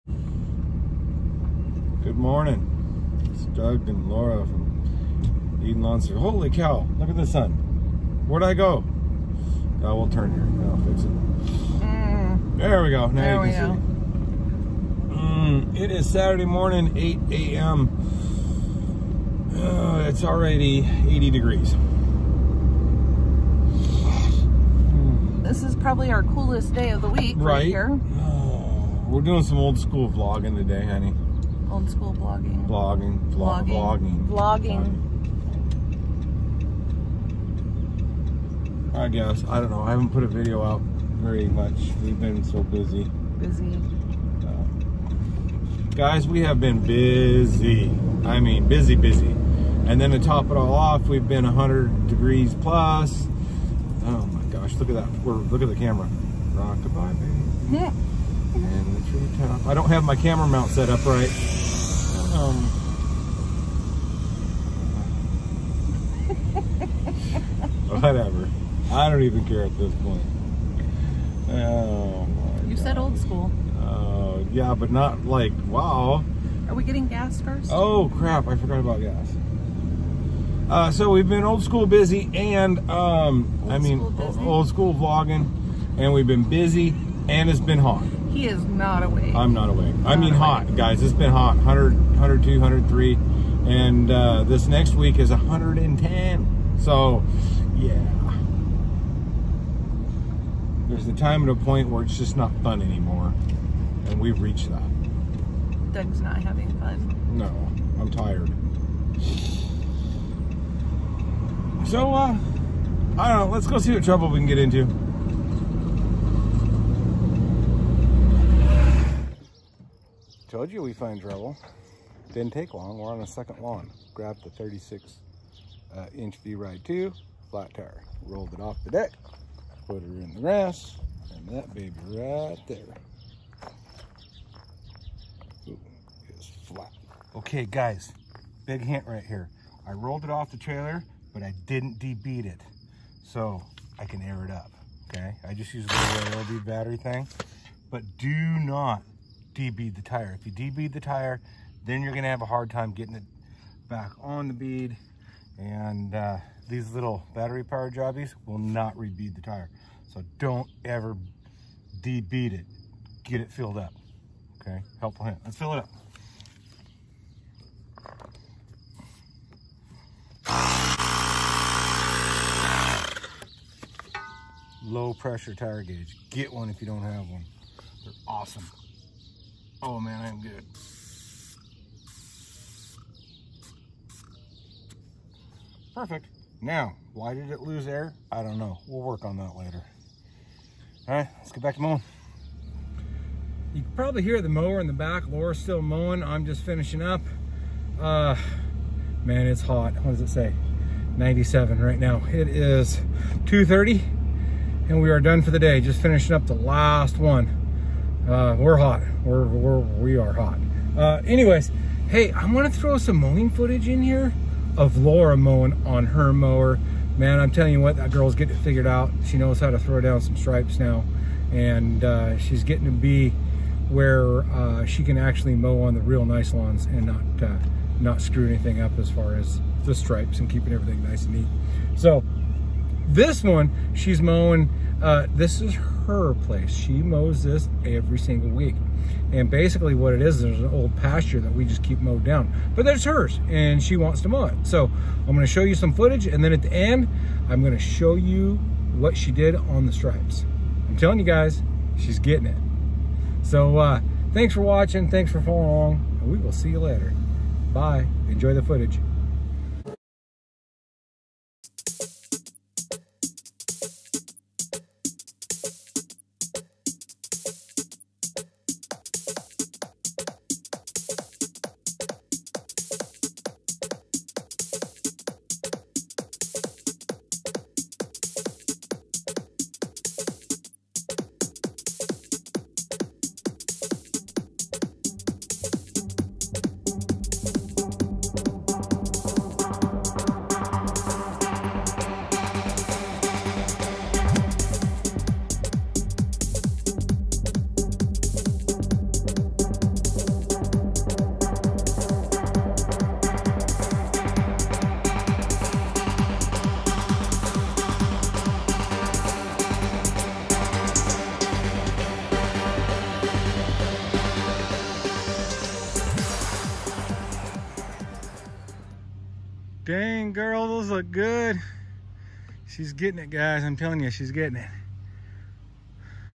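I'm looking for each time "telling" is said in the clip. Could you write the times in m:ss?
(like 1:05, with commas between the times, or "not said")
3:37, 4:10, 5:23.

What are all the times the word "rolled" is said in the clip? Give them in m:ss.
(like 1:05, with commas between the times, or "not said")
2:08, 2:19.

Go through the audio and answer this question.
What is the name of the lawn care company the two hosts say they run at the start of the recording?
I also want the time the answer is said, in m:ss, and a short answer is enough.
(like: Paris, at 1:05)
Eden Lawn Services, at 0:05.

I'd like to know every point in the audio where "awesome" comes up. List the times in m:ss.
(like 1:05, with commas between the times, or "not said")
2:58.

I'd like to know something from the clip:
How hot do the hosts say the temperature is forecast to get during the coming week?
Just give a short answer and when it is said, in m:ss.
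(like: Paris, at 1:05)
110, at 1:35.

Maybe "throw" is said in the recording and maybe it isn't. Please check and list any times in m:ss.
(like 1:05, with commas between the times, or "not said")
3:32, 3:39.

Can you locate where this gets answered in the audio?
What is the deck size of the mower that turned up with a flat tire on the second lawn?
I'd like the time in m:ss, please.
2:04.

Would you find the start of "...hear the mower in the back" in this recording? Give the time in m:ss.
3:14.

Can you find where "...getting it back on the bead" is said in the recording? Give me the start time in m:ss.
2:32.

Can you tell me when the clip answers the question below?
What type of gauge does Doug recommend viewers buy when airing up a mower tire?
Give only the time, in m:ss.
2:54.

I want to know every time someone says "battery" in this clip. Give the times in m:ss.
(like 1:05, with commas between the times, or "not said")
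2:26, 2:37.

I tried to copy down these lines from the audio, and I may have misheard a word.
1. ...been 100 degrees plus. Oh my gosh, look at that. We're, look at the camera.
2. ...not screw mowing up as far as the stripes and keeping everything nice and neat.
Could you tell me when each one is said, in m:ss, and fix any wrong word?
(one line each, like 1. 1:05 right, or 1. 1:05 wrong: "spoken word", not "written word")
1. 0:51 right
2. 3:47 wrong: "anything", not "mowing".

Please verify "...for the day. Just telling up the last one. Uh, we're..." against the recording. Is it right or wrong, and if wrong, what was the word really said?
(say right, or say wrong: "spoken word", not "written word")
wrong: "finishing", not "telling".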